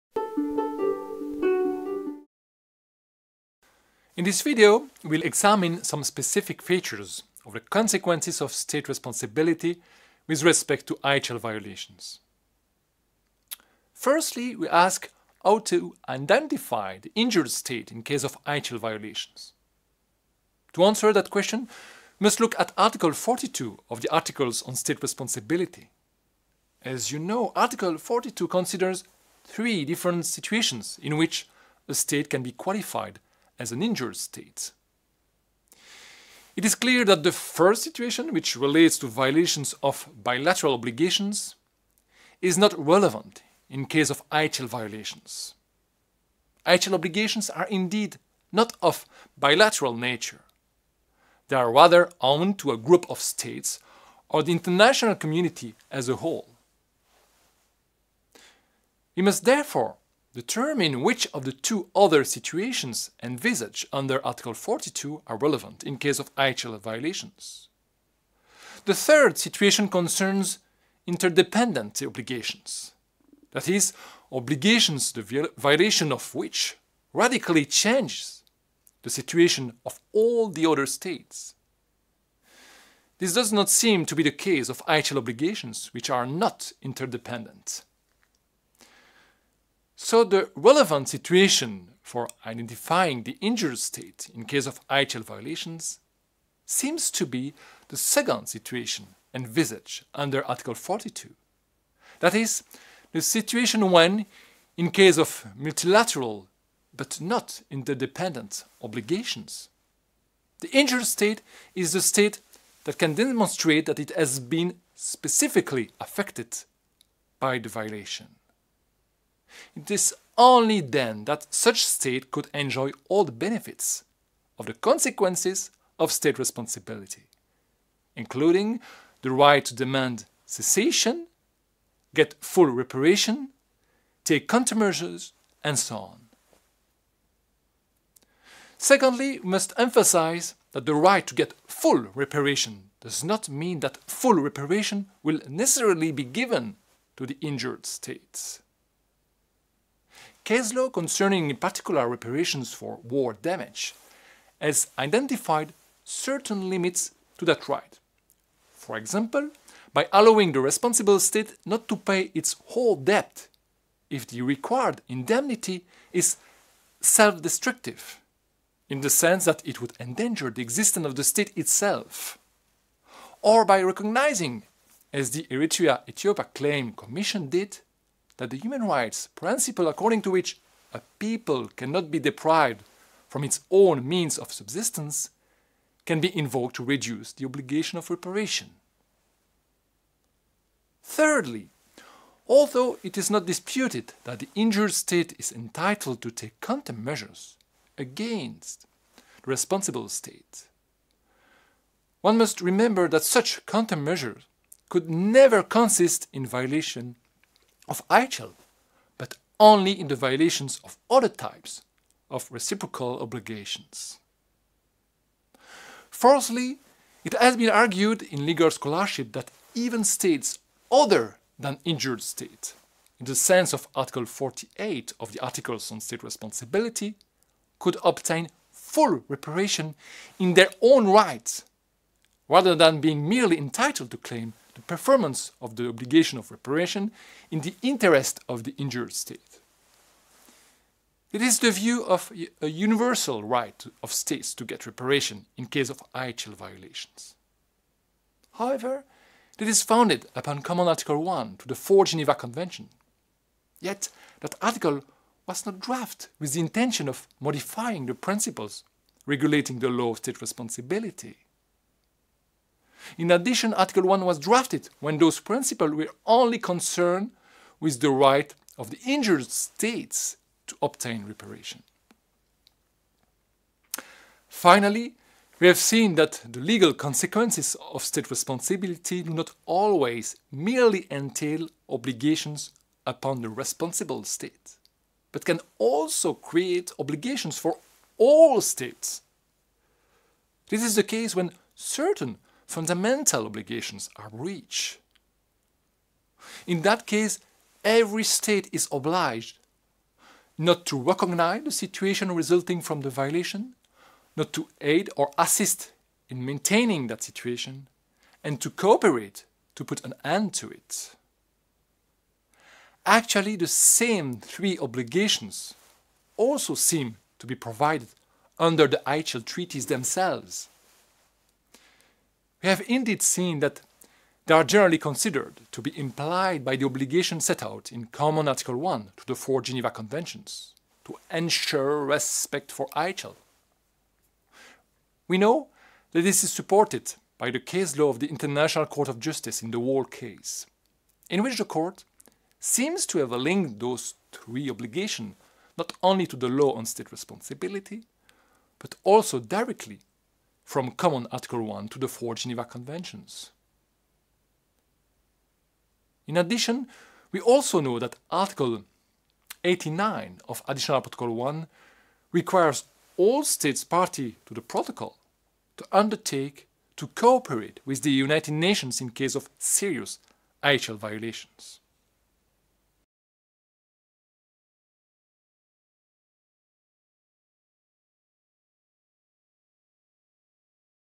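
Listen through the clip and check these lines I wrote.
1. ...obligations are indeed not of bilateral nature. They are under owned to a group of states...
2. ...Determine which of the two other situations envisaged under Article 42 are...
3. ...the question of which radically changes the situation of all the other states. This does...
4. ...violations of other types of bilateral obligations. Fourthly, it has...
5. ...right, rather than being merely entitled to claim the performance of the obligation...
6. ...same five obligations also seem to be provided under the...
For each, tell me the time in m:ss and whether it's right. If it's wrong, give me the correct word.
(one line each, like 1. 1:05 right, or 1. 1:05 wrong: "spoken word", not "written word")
1. 0:46 wrong: "rather", not "under"
2. 1:00 right
3. 1:15 wrong: "violation", not "question"
4. 3:30 wrong: "reciprocal", not "bilateral"
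5. 3:51 right
6. 5:13 wrong: "three", not "five".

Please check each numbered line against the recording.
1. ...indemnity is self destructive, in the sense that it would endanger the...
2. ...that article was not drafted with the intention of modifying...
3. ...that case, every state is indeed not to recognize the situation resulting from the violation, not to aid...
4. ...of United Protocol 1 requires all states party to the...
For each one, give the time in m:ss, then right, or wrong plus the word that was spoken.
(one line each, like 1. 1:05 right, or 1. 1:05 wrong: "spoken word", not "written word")
1. 2:45 right
2. 4:14 right
3. 4:56 wrong: "obliged", not "indeed"
4. 6:00 wrong: "Additional", not "United".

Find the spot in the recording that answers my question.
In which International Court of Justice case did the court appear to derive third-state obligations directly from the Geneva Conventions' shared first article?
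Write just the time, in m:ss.
5:39.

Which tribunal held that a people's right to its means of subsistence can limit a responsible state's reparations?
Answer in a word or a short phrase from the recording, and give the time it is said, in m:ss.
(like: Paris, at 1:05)
Eritrea Ethiopia Claim Commission, at 2:55.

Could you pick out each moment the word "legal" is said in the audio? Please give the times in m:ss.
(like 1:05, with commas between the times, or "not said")
3:38, 4:36.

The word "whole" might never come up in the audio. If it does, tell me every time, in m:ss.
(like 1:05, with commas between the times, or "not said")
0:56, 2:42.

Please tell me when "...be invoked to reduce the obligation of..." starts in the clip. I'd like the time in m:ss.
3:06.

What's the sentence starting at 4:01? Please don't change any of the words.
It is the view of a universal right of states to get reparation in case of IHL violations.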